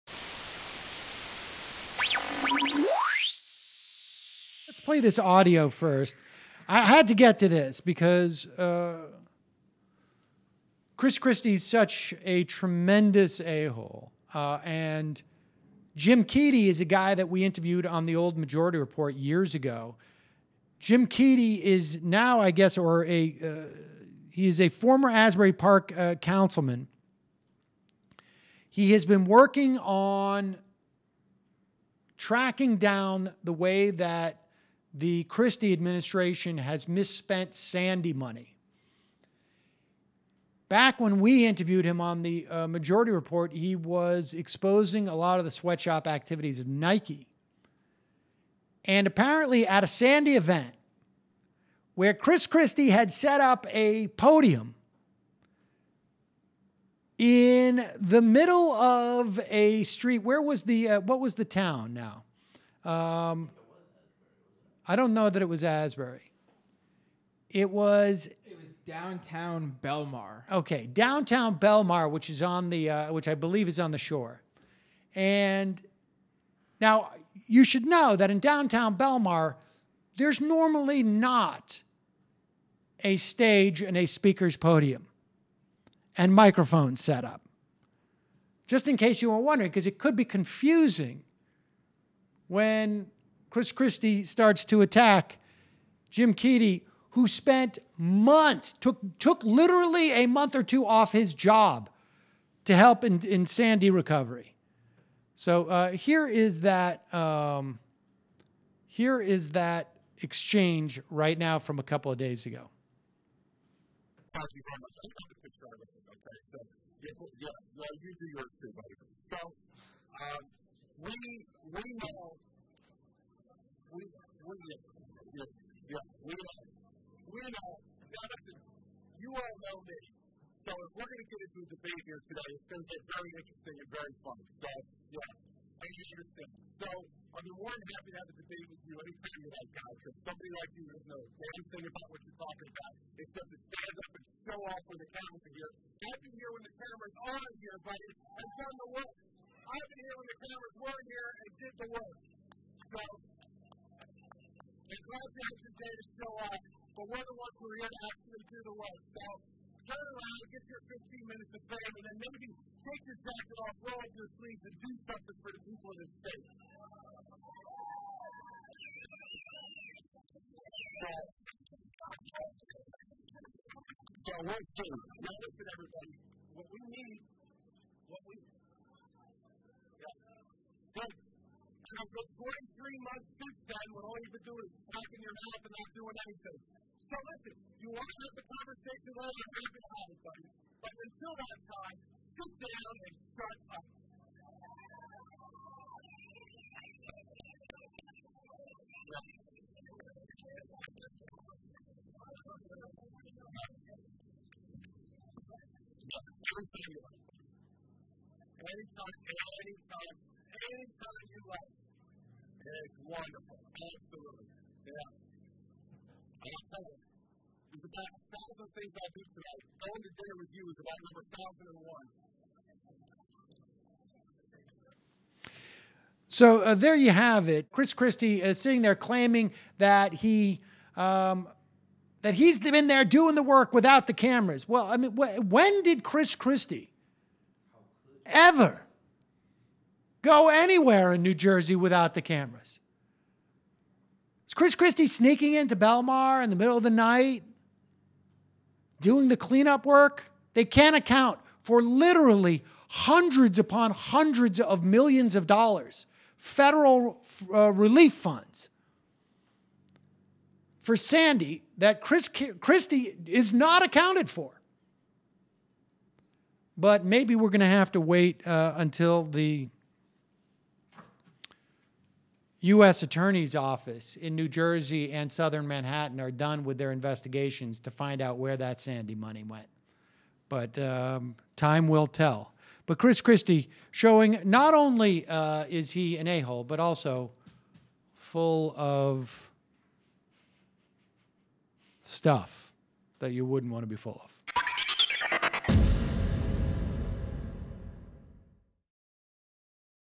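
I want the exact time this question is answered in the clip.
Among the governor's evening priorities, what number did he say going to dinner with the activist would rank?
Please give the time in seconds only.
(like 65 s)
221 s.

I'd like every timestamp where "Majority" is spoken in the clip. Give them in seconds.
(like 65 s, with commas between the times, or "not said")
18 s, 42 s.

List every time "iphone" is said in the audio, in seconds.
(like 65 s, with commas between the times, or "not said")
not said.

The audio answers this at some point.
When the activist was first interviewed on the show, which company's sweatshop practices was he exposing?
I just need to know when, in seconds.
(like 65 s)
46 s.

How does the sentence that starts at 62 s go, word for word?
Um, I don't know that it was Asbury.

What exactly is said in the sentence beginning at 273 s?
Attorney's Office in New Jersey and southern Manhattan are done with their investigations to find out where that Sandy money went.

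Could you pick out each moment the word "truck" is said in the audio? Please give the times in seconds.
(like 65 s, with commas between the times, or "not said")
not said.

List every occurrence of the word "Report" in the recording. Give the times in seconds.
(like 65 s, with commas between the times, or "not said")
18 s, 43 s.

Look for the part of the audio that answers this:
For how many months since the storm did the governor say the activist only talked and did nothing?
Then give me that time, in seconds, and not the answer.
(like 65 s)
182 s.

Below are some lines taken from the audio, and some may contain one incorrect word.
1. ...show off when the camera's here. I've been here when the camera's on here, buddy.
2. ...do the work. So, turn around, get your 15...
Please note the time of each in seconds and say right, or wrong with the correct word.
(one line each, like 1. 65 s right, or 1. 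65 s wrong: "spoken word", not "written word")
1. 144 s right
2. 158 s right.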